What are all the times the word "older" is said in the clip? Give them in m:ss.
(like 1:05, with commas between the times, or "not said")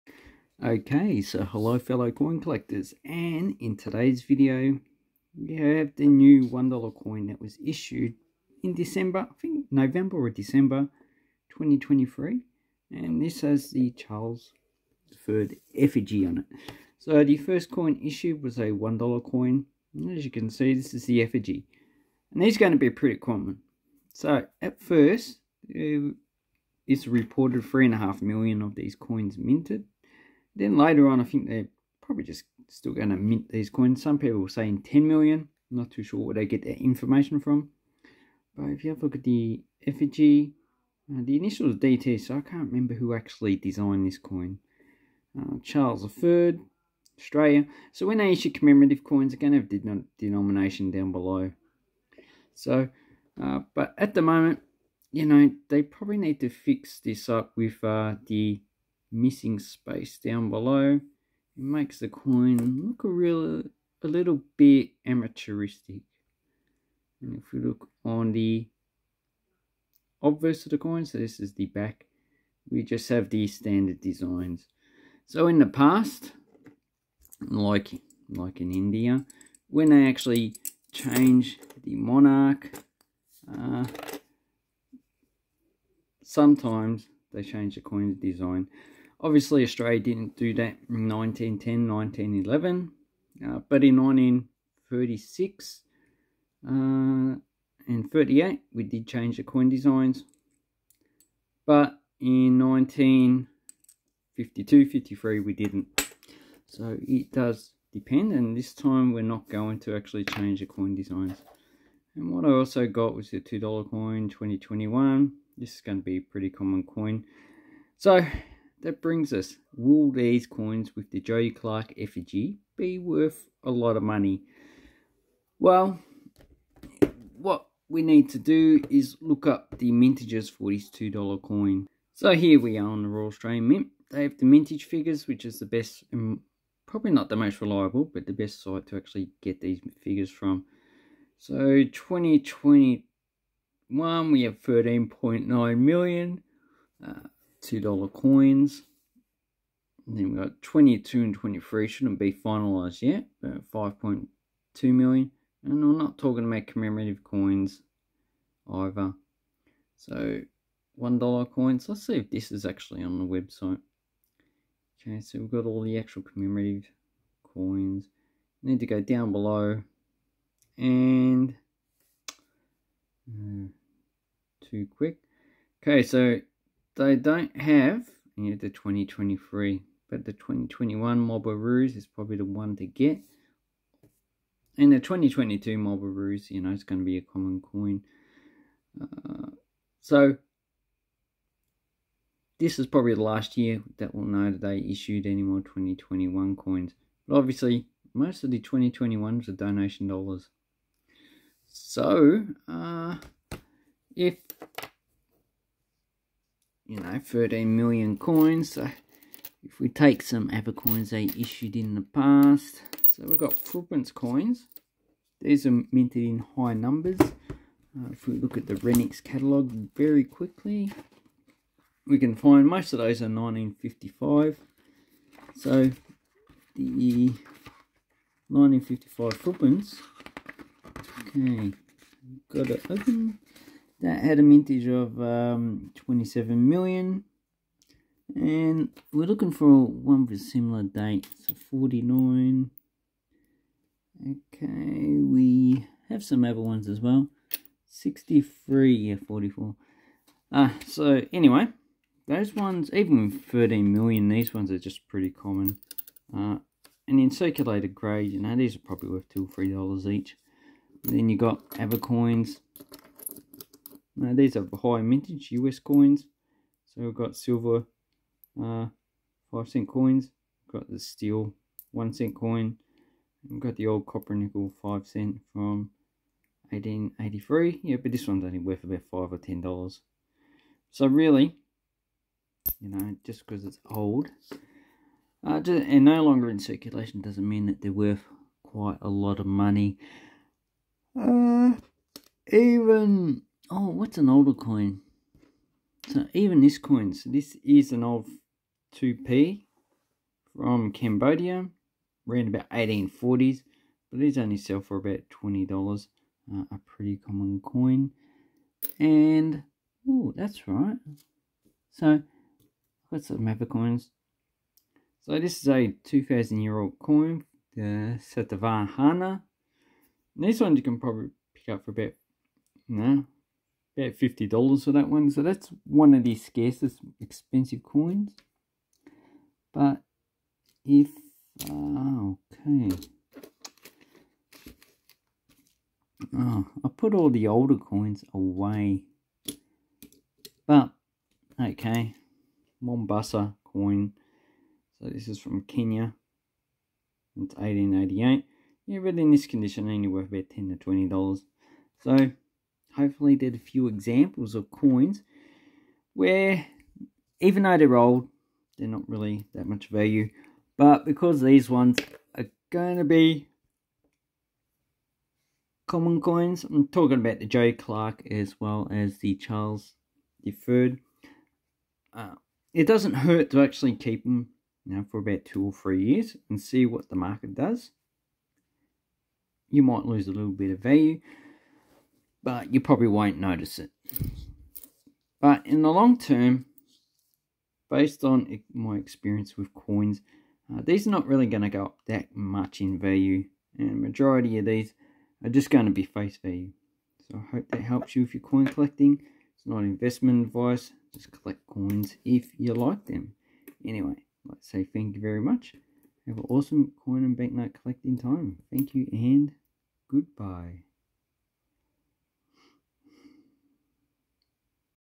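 4:54, 5:37.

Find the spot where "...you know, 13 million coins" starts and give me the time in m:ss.
3:26.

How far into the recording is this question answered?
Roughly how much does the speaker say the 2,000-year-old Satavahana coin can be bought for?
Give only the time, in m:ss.
5:24.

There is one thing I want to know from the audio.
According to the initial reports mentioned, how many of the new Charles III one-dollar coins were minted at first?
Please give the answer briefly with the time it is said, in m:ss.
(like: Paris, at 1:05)
3.5 million, at 0:27.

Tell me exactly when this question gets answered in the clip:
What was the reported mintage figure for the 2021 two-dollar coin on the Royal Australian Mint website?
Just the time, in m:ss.
2:24.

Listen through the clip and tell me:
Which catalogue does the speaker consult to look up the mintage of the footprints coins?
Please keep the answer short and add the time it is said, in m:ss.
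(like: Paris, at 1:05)
Renniks, at 3:38.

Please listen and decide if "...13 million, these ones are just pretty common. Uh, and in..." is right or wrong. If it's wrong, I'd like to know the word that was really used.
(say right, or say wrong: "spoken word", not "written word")
right.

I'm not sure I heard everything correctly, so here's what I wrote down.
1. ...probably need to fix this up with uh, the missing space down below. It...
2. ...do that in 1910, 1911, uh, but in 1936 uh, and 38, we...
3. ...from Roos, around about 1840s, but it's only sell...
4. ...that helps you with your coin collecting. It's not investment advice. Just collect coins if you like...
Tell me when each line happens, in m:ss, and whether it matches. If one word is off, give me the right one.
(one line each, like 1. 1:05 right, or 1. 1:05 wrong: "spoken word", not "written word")
1. 0:55 right
2. 1:30 right
3. 5:00 wrong: "Cambodia", not "Roos"
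4. 6:37 right.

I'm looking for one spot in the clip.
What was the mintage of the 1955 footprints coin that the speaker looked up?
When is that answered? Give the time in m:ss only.
3:55.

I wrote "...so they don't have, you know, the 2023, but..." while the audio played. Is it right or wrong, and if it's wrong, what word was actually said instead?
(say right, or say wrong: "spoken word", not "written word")
right.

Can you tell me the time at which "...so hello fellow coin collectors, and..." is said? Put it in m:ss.
0:01.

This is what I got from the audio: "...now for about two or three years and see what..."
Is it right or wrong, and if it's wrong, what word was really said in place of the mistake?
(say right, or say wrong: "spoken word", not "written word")
right.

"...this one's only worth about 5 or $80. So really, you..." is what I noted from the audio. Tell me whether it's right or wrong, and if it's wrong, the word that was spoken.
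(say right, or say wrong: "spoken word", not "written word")
wrong: "10", not "80".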